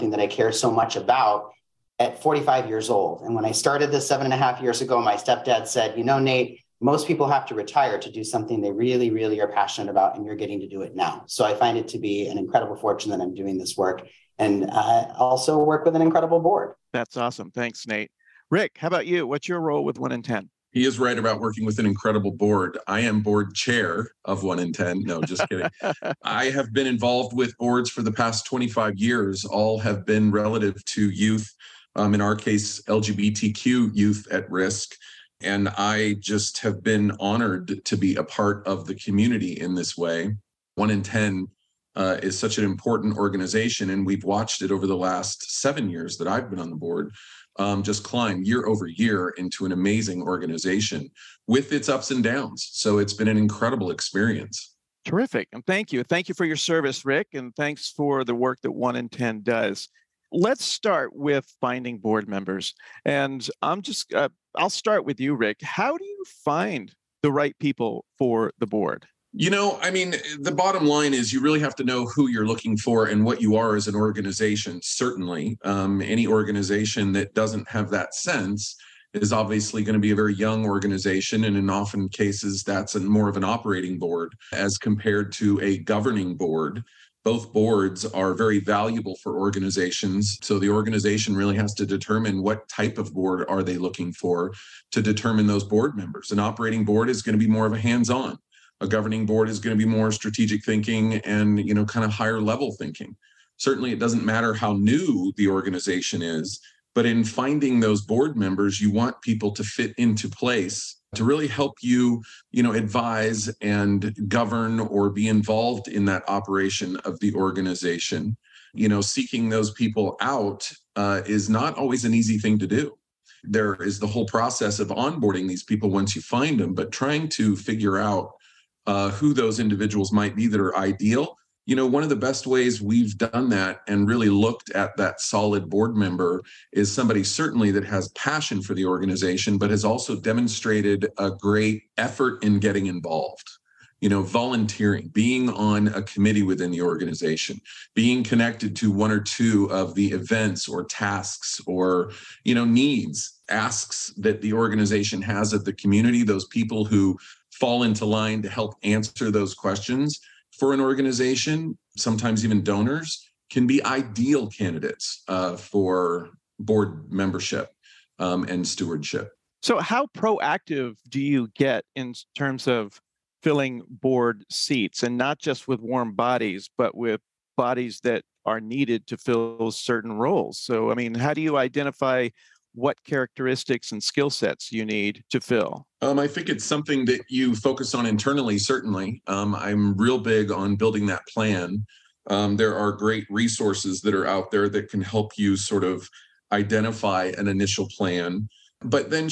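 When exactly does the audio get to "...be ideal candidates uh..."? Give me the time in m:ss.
2:43.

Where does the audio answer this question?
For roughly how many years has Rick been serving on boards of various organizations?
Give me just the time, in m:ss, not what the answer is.
0:28.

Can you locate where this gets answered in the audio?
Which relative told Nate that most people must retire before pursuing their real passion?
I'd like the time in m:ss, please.
0:05.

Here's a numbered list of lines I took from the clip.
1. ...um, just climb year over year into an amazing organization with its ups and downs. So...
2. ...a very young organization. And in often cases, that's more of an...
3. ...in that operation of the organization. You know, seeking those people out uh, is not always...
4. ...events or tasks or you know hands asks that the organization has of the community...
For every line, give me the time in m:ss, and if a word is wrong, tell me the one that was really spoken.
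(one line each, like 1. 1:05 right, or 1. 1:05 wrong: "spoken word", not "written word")
1. 0:47 right
2. 1:20 right
3. 1:55 right
4. 2:30 wrong: "needs", not "hands".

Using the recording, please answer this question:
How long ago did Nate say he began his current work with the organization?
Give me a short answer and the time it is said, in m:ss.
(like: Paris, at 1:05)
7.5 years, at 0:04.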